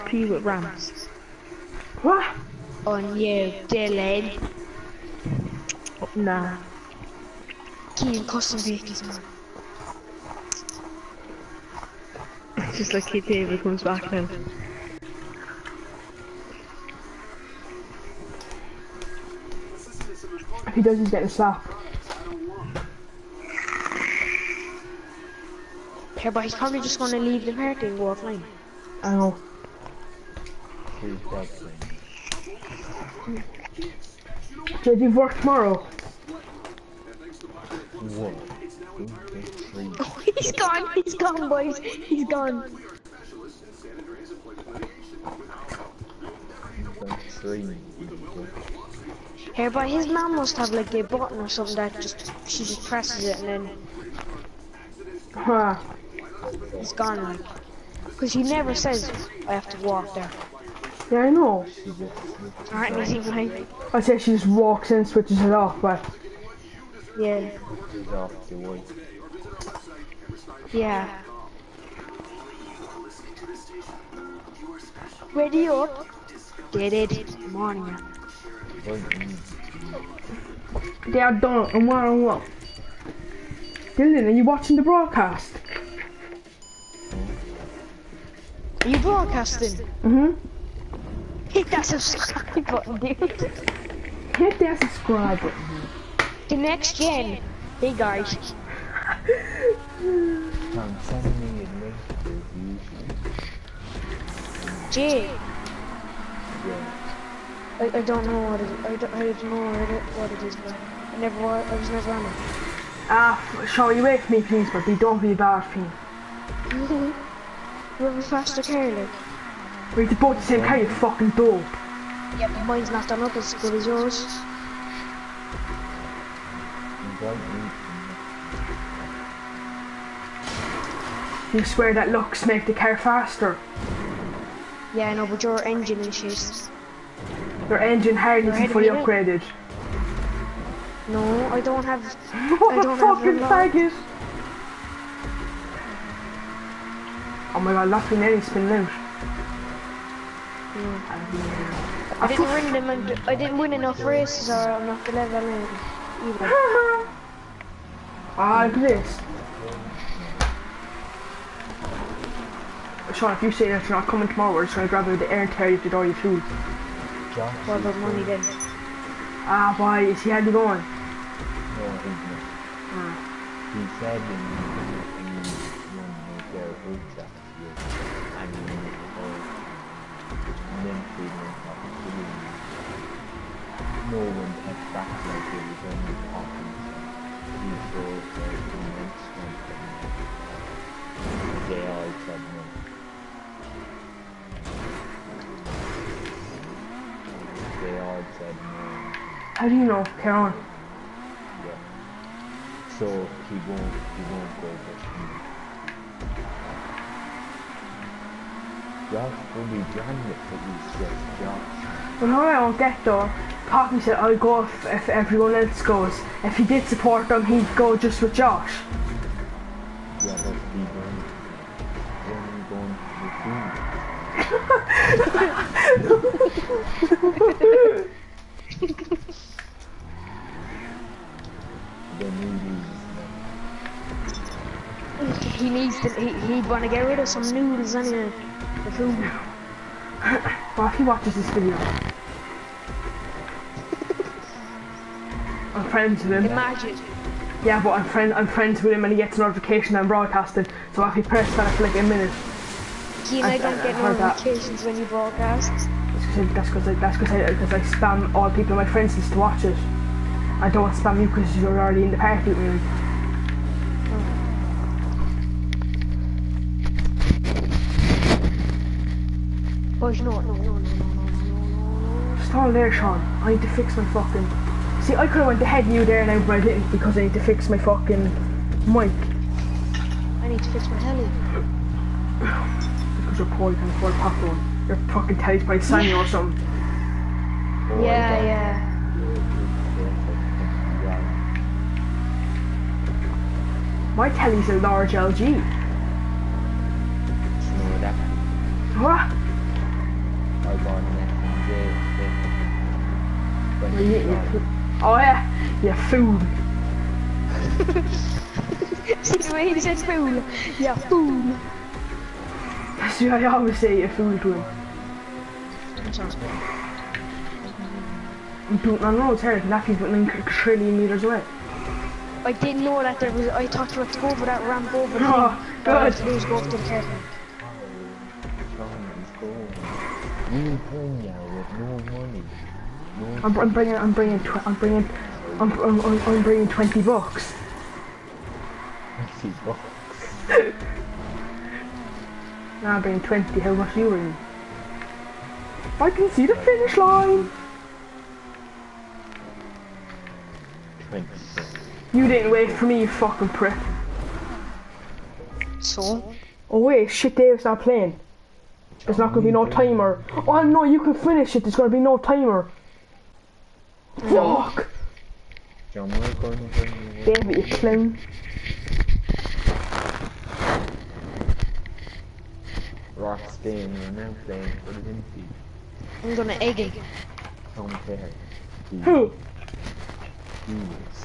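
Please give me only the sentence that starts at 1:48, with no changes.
I don't, I don't know what it, what it is, but I never I was never on it.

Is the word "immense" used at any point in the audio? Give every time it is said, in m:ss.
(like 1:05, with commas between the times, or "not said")
3:08.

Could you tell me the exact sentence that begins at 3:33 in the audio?
Poppy said I'll go if, if everyone else goes.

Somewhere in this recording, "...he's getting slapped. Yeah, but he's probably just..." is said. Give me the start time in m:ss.
0:20.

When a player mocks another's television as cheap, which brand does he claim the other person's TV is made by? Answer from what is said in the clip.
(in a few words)
Sanyo.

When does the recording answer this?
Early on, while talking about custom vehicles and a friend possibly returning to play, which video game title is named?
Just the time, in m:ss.
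0:13.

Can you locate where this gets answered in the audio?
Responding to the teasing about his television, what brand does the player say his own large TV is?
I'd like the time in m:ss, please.
4:55.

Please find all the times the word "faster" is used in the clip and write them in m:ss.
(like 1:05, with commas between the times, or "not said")
1:58, 2:12.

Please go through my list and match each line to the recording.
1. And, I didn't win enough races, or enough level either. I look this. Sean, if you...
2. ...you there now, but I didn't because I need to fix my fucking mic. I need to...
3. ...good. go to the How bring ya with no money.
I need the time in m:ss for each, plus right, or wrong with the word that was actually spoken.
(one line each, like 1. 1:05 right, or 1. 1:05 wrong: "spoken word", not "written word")
1. 2:32 right
2. 4:35 right
3. 5:25 wrong: "You", not "How".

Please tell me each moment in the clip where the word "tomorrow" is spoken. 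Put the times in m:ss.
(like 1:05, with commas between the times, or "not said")
0:35, 2:44.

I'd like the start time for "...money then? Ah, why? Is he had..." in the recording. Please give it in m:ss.
2:47.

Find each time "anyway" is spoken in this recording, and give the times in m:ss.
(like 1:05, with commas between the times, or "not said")
3:57.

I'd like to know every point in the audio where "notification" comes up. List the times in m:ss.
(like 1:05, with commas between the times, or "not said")
4:09, 4:14.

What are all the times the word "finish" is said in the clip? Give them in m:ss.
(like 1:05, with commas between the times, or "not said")
5:46, 6:01.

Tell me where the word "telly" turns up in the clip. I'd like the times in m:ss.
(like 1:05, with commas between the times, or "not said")
4:45, 4:54.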